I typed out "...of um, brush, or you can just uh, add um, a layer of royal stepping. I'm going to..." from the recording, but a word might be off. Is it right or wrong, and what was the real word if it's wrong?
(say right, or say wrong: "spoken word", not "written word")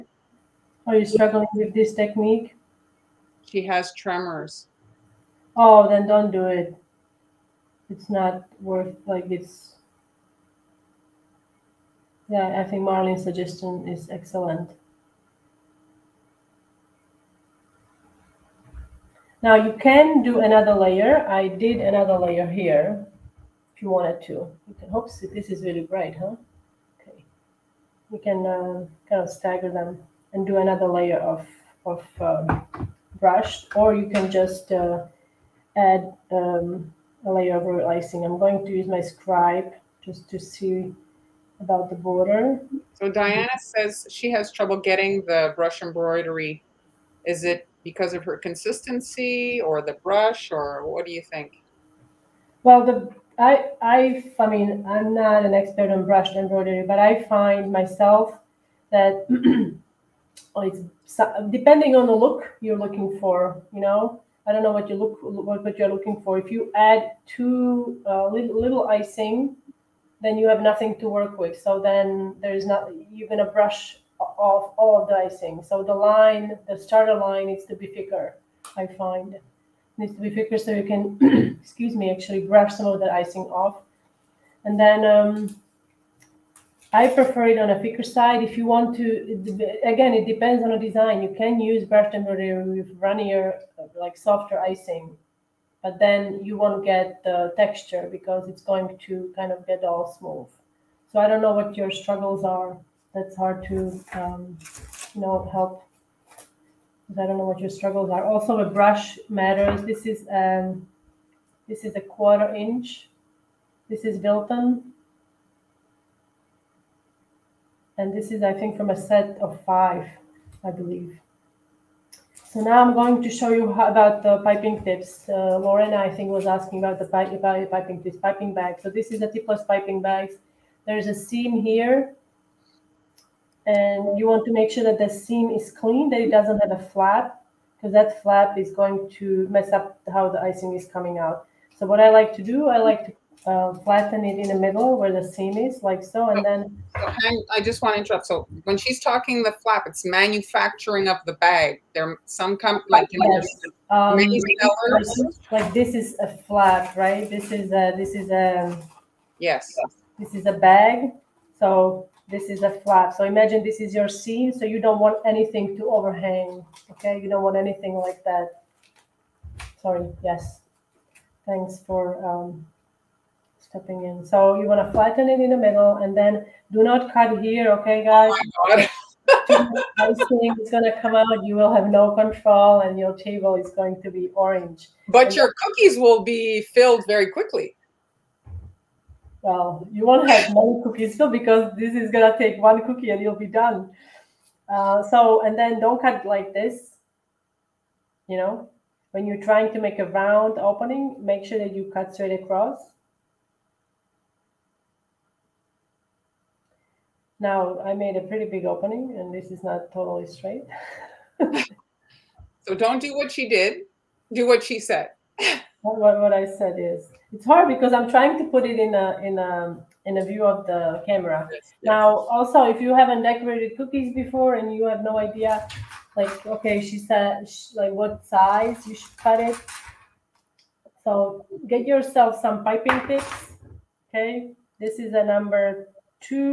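wrong: "icing", not "stepping".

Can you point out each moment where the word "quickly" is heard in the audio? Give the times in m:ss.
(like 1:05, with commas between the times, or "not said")
3:07.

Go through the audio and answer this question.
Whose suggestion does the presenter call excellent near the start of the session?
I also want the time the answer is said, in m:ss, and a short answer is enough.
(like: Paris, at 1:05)
Marlene, at 0:12.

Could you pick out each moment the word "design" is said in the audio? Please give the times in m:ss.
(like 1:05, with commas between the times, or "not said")
1:30.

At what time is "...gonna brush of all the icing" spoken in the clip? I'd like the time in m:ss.
1:13.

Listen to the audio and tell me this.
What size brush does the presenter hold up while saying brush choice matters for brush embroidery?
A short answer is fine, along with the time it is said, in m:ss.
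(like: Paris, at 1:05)
quarter inch, at 1:51.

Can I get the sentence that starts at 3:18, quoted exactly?
You know, when you're trying to make a round opening, make sure that you cut straight across.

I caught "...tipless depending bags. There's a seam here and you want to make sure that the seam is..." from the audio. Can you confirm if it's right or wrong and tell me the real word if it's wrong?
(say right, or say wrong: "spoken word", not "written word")
wrong: "piping", not "depending".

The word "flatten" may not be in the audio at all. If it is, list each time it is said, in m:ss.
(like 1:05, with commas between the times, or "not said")
2:23, 2:54.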